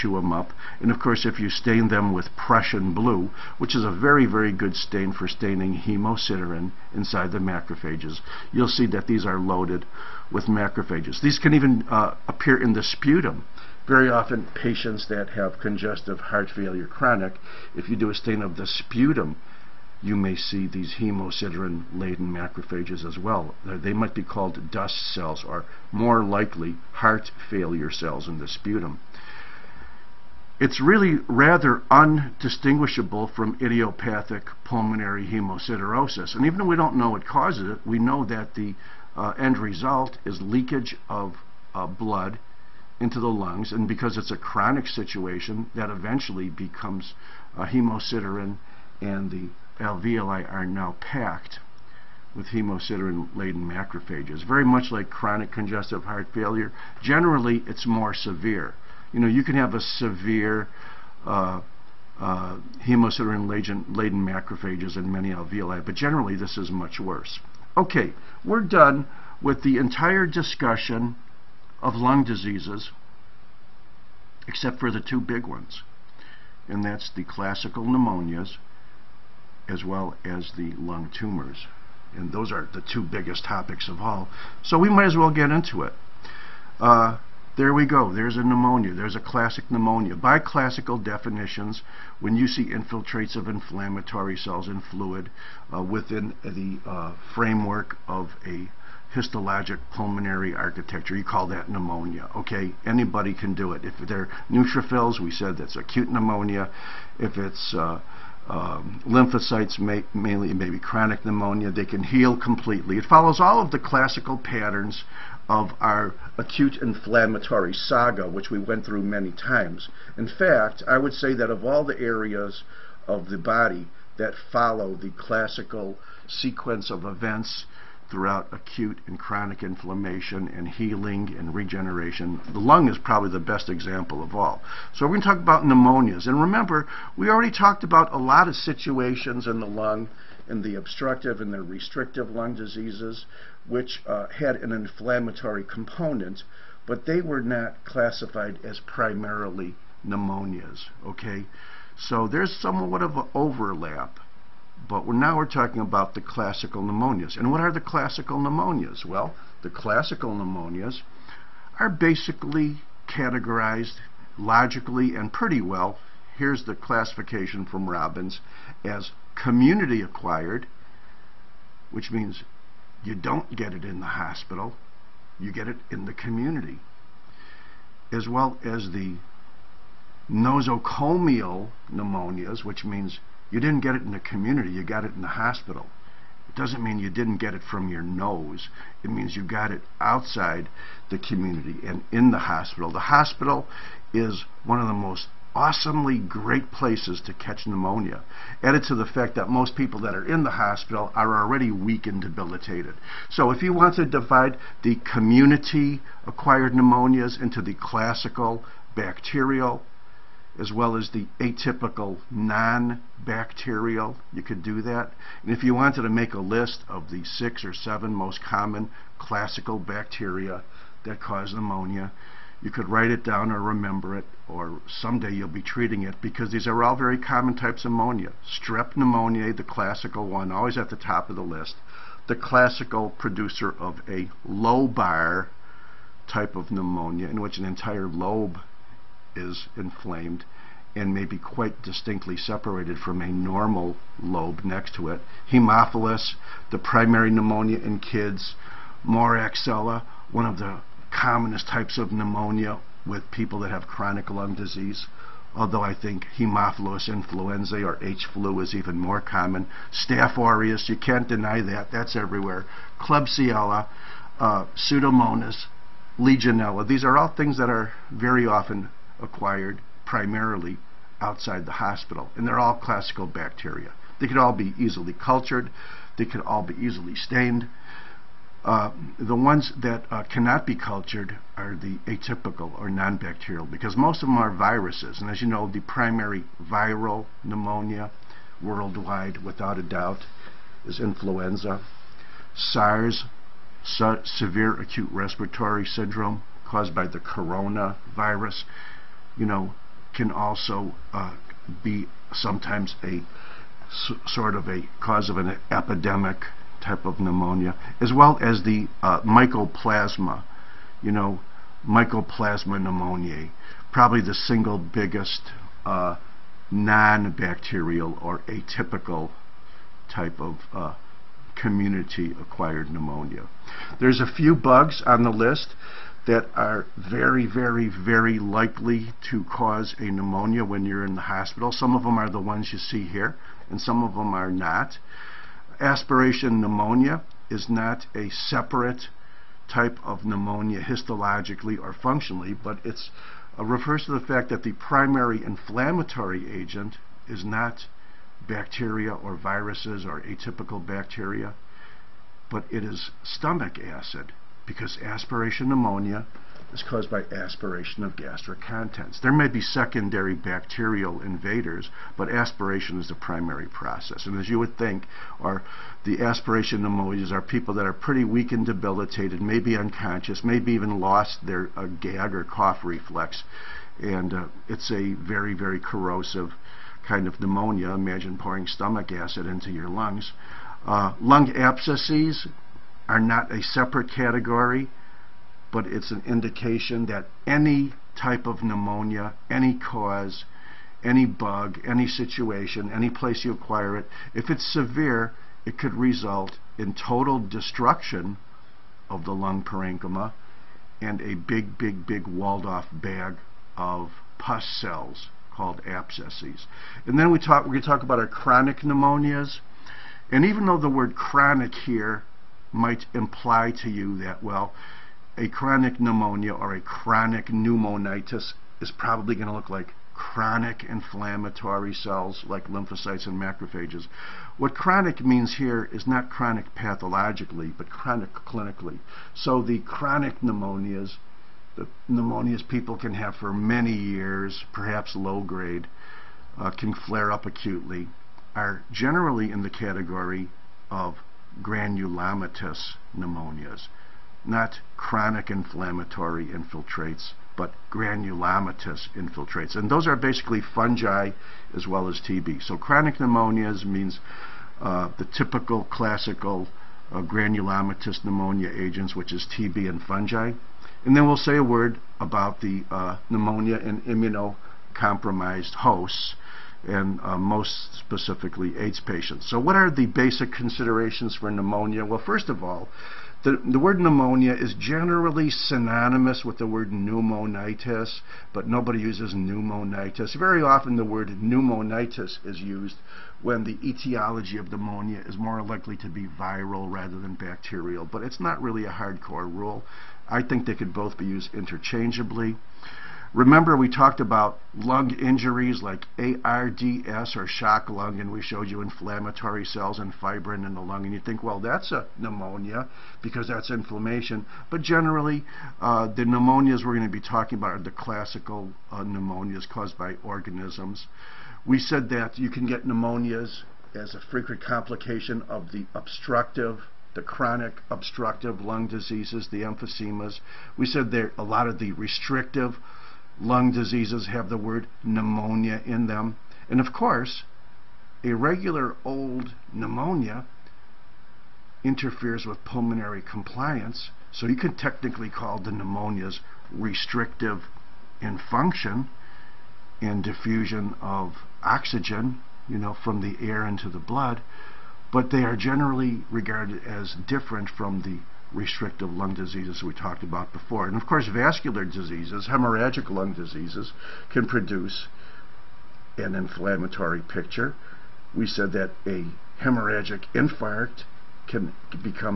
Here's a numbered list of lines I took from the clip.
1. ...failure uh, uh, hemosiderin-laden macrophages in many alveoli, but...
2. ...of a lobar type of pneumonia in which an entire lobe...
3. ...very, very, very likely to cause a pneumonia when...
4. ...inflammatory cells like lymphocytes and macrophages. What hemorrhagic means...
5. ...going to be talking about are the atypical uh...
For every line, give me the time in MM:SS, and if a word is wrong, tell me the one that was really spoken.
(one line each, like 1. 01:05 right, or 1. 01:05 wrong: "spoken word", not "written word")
1. 00:59 wrong: "severe", not "failure"
2. 03:53 right
3. 05:26 right
4. 07:00 wrong: "chronic", not "hemorrhagic"
5. 08:26 wrong: "classical", not "atypical".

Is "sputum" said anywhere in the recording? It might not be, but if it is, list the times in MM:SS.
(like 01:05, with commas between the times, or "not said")
00:12, 00:18, 00:28.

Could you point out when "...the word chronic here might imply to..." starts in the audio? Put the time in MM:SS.
06:50.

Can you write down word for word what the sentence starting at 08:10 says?
I think they could both be used interchangeably.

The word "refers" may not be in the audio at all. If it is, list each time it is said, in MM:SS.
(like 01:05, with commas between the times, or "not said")
05:43.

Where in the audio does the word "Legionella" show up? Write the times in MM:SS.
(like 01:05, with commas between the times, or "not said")
04:26.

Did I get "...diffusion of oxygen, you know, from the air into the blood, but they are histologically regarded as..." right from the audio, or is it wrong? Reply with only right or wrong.
wrong.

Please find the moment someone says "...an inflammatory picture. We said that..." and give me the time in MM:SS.
09:16.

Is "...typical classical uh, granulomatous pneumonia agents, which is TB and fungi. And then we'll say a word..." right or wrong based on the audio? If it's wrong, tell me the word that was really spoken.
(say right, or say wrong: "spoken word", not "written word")
right.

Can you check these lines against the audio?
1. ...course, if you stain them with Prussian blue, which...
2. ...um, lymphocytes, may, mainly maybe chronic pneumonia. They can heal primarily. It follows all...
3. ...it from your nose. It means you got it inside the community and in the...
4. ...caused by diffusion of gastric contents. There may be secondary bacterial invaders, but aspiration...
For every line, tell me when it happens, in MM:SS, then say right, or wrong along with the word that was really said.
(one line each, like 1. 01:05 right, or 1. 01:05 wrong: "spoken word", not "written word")
1. 00:00 right
2. 01:48 wrong: "completely", not "primarily"
3. 03:07 wrong: "outside", not "inside"
4. 05:56 wrong: "aspiration", not "diffusion".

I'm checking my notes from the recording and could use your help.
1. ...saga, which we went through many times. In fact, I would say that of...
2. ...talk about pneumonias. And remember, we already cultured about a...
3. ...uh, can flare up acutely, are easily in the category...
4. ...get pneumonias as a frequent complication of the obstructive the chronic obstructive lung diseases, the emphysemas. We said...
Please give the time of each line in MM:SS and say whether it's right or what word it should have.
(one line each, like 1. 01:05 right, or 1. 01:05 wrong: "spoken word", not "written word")
1. 01:57 right
2. 02:15 wrong: "talked", not "cultured"
3. 07:16 wrong: "generally", not "easily"
4. 08:32 right.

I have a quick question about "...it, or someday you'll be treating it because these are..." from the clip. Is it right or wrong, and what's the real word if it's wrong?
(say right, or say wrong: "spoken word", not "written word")
right.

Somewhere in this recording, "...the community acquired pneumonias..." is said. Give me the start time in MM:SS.
03:24.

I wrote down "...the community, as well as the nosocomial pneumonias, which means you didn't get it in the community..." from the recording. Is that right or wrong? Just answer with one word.
right.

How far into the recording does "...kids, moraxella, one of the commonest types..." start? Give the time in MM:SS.
04:07.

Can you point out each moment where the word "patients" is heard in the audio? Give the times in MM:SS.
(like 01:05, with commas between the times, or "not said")
00:14, 07:49.